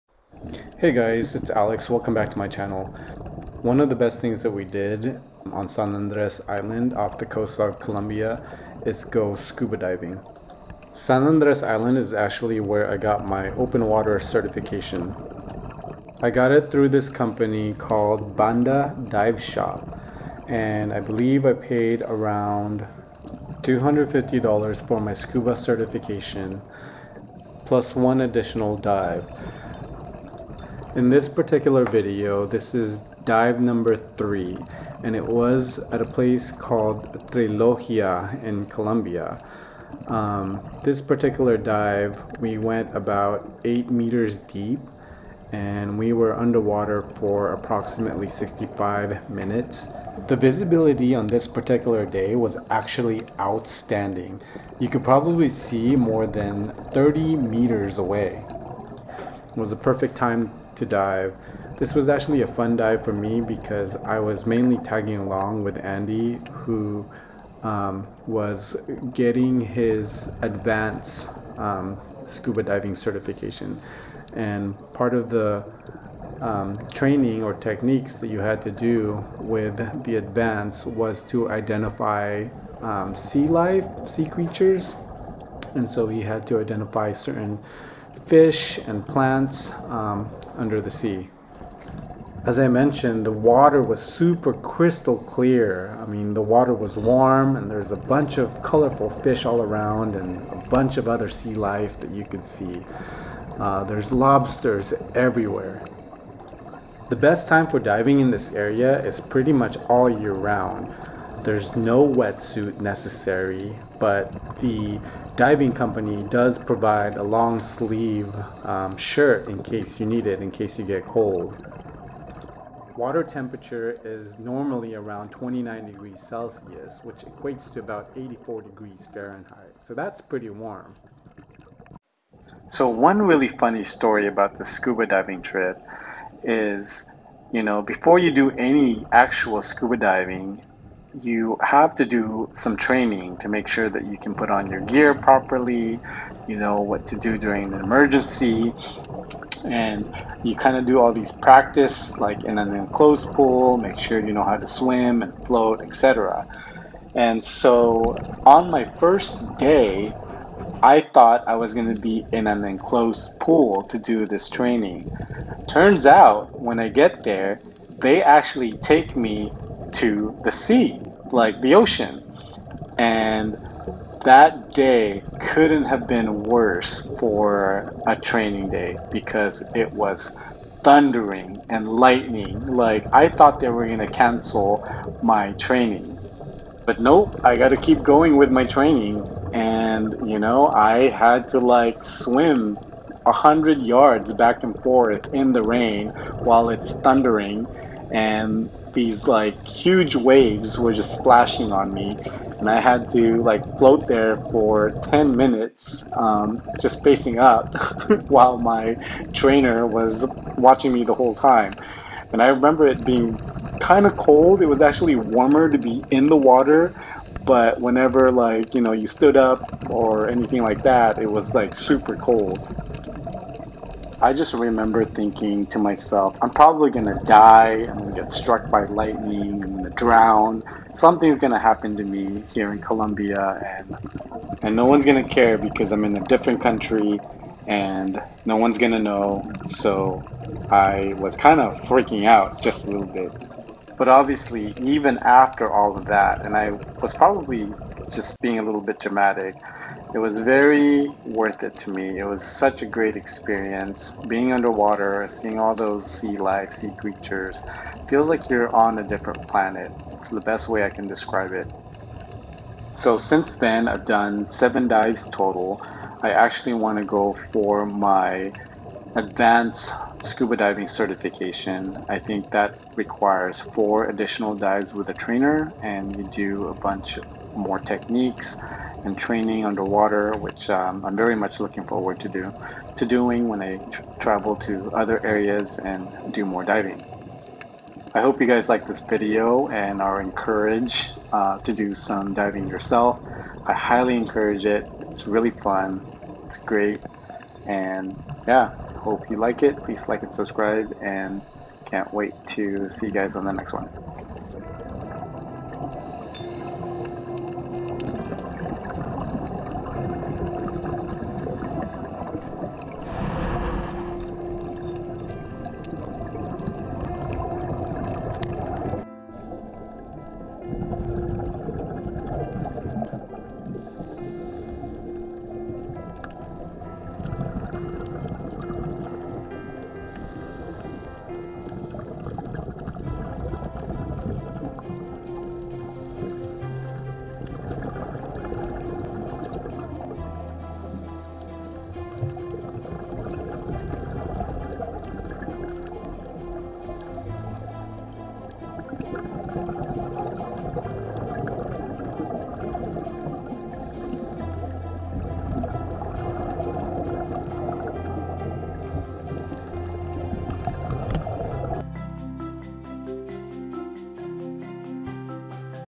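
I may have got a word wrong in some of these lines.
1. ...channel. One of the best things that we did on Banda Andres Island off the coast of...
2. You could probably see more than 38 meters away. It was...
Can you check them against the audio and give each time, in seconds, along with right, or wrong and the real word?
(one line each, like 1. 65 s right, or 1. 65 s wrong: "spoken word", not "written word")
1. 2 s wrong: "San", not "Banda"
2. 54 s wrong: "30", not "38".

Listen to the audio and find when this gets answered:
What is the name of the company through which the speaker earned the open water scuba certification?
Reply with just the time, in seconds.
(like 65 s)
18 s.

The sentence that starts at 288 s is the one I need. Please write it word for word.
I hope you guys like this video and are encouraged uh, to do some diving yourself.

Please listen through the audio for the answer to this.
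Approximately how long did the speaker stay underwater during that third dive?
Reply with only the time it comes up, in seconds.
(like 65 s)
48 s.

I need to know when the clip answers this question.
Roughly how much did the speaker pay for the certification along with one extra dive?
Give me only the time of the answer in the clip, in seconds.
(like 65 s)
23 s.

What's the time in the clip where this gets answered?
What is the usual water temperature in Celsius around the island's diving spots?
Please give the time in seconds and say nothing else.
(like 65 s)
125 s.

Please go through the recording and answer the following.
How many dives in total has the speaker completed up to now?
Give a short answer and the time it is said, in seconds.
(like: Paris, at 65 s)
7, at 264 s.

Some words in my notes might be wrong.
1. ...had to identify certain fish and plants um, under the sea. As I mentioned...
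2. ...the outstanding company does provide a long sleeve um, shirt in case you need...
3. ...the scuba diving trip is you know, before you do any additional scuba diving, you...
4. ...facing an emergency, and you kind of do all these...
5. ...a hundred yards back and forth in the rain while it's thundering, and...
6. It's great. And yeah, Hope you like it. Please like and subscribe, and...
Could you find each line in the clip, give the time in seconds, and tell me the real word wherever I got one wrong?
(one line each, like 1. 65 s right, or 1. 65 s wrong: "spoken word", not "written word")
1. 86 s right
2. 114 s wrong: "diving", not "outstanding"
3. 134 s wrong: "actual", not "additional"
4. 147 s wrong: "during", not "facing"
5. 193 s right
6. 296 s right.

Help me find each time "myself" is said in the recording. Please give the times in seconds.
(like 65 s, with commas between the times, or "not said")
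225 s.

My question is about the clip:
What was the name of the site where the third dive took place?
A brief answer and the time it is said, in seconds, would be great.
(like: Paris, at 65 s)
Trilogia, at 37 s.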